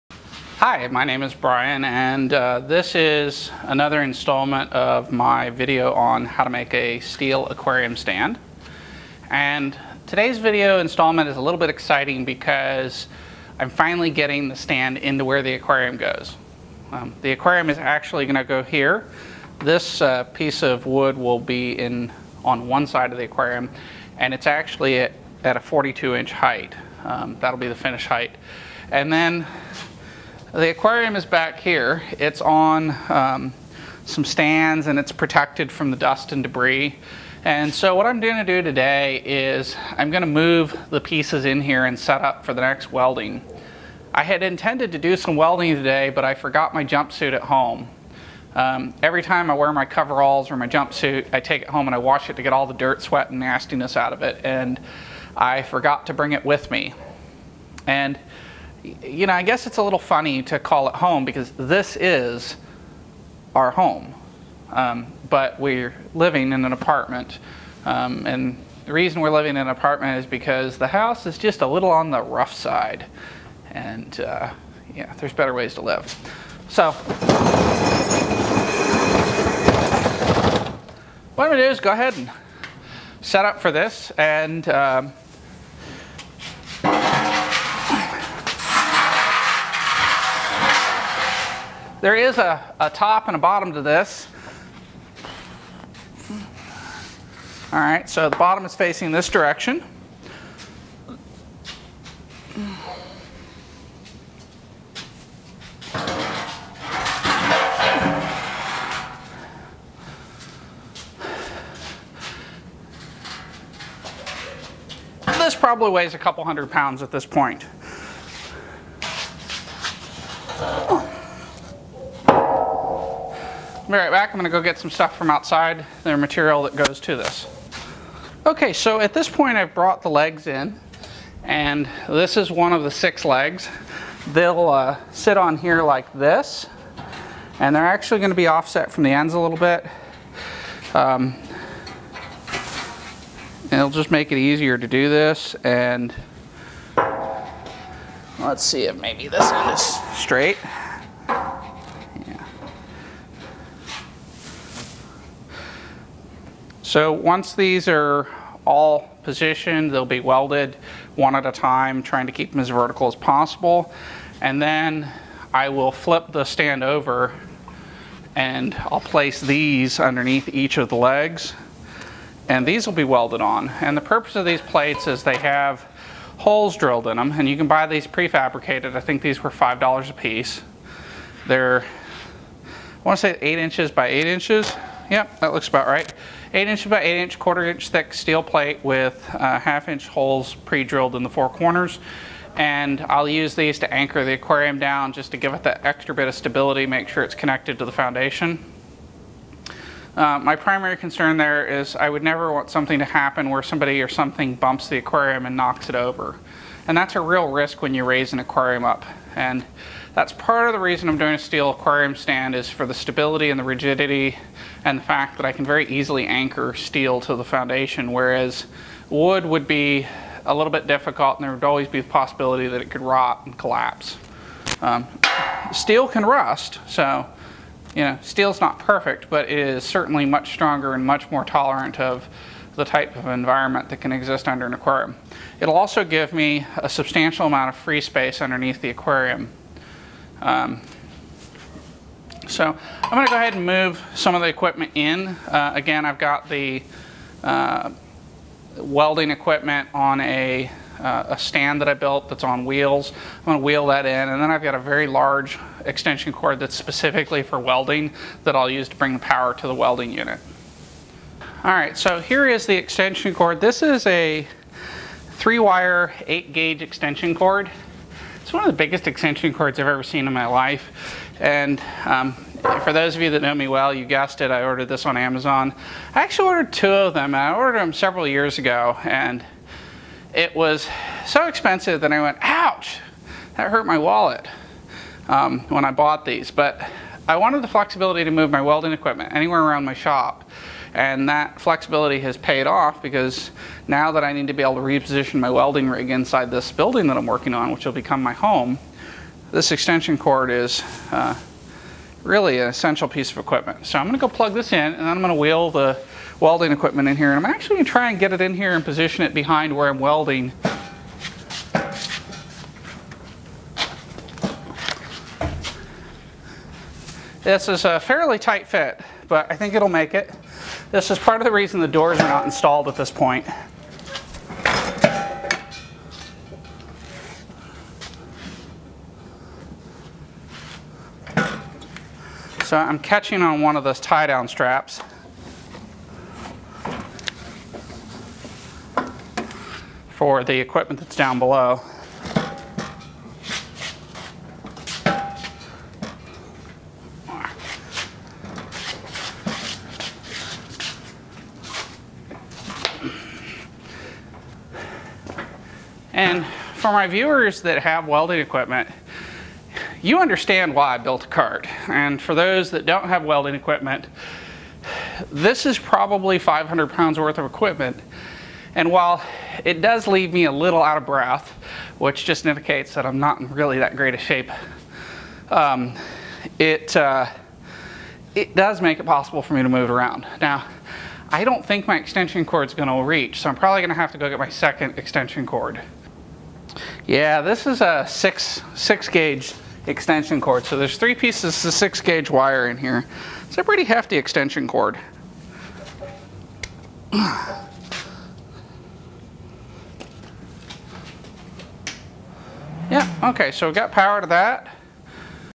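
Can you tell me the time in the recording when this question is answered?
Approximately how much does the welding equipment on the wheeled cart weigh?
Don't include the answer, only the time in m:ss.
6:06.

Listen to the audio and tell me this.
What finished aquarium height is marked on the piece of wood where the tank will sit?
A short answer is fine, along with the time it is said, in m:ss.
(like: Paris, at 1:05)
42 inches, at 0:25.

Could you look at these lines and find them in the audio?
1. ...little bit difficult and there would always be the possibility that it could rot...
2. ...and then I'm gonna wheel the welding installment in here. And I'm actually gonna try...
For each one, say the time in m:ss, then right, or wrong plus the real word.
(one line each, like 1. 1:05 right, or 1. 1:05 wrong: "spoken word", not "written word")
1. 3:40 right
2. 5:04 wrong: "equipment", not "installment".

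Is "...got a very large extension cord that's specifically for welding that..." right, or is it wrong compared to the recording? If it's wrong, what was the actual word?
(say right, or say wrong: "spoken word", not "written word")
right.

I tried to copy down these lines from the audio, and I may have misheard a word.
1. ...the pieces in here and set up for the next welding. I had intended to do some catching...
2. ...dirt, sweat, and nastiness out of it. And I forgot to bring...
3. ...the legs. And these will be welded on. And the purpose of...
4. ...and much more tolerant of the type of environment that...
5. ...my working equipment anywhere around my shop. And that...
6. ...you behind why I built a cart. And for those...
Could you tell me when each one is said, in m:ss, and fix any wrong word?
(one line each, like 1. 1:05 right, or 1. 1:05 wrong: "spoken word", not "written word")
1. 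0:40 wrong: "welding", not "catching"
2. 0:52 right
3. 2:50 right
4. 3:50 right
5. 4:48 wrong: "welding", not "working"
6. 6:00 wrong: "understand", not "behind".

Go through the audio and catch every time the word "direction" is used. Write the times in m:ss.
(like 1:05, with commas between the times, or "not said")
1:39.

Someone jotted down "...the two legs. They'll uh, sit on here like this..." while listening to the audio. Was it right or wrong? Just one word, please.
wrong.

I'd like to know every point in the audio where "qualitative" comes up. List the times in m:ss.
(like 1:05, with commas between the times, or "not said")
not said.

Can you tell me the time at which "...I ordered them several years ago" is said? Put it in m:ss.
4:37.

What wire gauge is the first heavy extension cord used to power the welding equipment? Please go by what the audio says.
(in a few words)
8 gauge.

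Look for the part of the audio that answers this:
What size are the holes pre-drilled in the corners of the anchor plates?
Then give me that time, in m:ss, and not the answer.
3:09.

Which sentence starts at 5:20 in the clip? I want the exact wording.
This is part of the reason the doors are not installed at this point.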